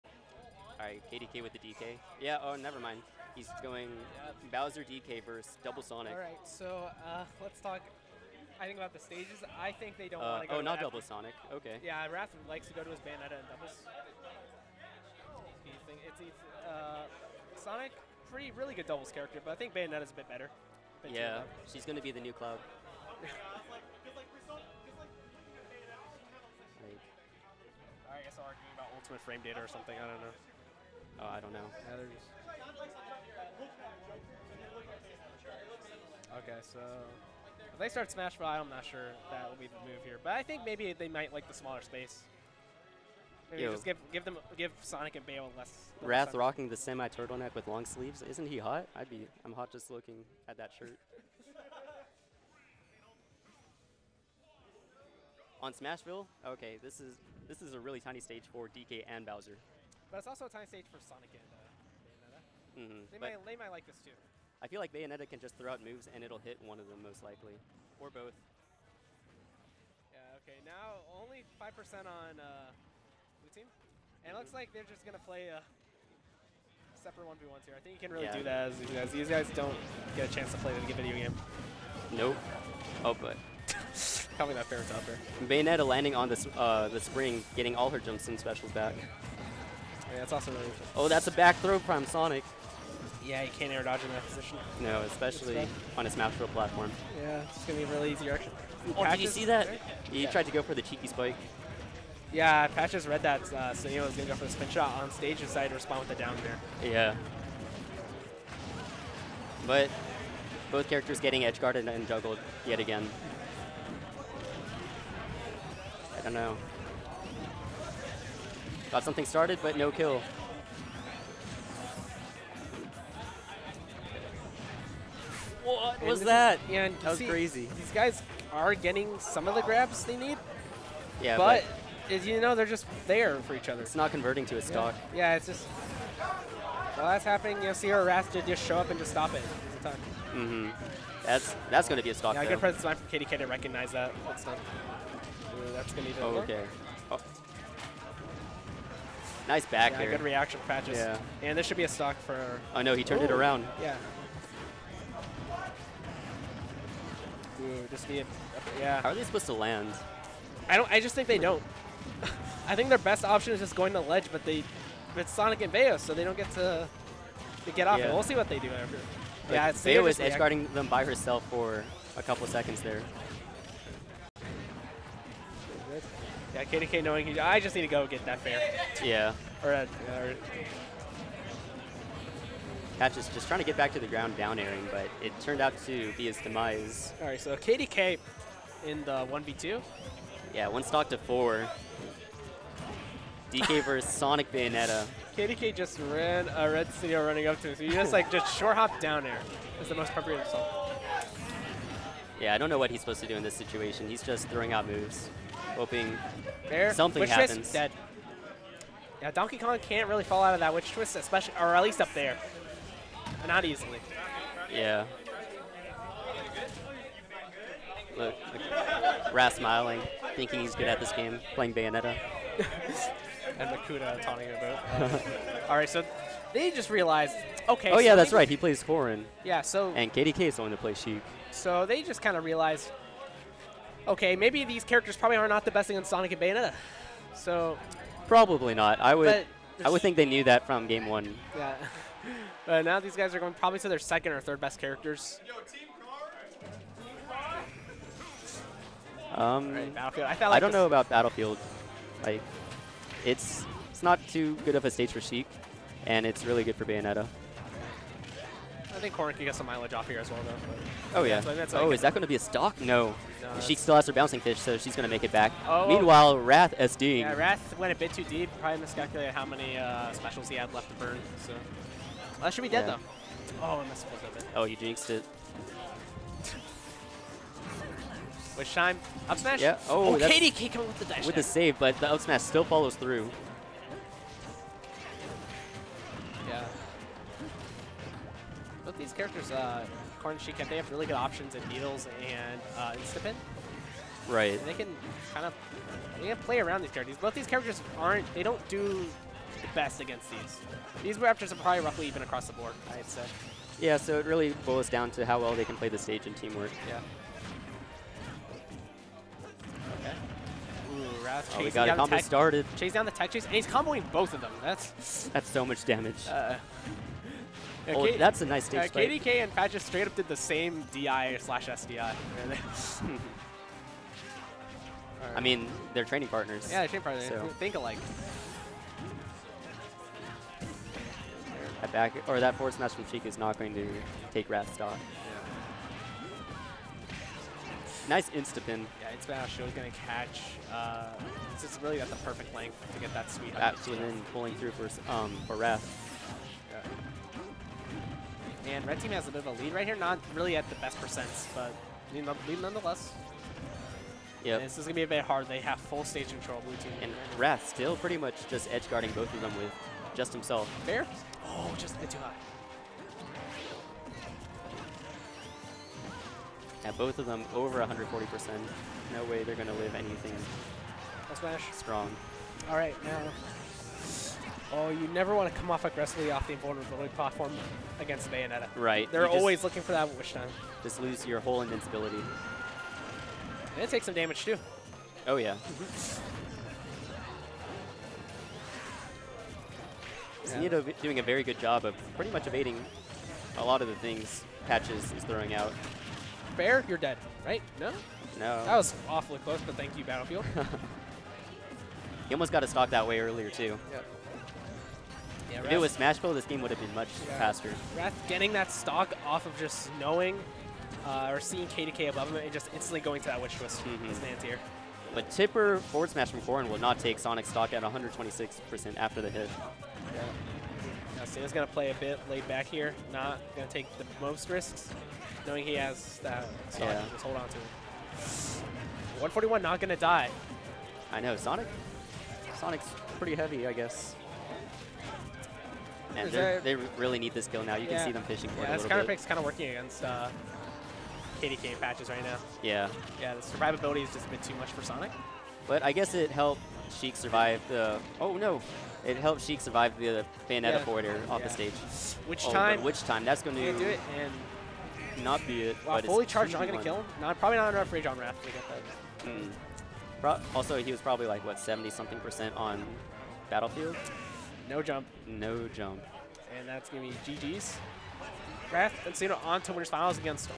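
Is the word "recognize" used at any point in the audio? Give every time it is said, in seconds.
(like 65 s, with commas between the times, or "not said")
143 s.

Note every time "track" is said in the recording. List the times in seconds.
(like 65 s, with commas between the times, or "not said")
not said.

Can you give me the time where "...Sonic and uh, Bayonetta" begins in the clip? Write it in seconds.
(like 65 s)
61 s.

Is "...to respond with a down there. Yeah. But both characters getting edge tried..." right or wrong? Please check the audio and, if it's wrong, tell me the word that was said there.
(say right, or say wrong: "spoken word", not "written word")
wrong: "guarded", not "tried".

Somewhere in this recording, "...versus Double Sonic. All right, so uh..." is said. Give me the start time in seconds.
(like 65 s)
5 s.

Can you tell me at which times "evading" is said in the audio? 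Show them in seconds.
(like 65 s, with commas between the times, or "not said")
392 s.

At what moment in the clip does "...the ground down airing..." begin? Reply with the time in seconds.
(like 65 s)
183 s.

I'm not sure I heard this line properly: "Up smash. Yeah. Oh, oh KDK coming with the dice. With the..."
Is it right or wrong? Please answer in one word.
right.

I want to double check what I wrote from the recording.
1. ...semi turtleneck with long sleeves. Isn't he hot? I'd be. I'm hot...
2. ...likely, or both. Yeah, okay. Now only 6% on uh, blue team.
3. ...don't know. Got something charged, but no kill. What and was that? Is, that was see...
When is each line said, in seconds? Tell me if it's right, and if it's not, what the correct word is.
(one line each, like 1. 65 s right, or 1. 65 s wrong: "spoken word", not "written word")
1. 46 s right
2. 67 s wrong: "5", not "6"
3. 116 s wrong: "started", not "charged".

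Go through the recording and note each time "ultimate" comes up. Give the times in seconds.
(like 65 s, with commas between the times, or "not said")
28 s.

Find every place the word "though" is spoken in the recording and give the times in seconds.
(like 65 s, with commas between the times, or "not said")
142 s, 260 s, 272 s.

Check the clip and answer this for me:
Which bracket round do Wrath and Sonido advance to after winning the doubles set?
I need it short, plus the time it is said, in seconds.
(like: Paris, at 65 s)
Winners Finals, at 469 s.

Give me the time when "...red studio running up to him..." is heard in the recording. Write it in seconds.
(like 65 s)
196 s.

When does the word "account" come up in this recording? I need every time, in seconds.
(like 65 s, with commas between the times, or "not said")
not said.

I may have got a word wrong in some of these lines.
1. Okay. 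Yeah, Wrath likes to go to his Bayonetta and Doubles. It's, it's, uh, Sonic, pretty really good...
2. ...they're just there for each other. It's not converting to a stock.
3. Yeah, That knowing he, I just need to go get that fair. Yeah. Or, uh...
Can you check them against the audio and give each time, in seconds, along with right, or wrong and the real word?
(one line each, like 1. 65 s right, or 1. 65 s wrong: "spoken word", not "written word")
1. 11 s right
2. 132 s right
3. 176 s wrong: "KDK", not "That".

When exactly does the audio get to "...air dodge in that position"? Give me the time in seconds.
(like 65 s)
93 s.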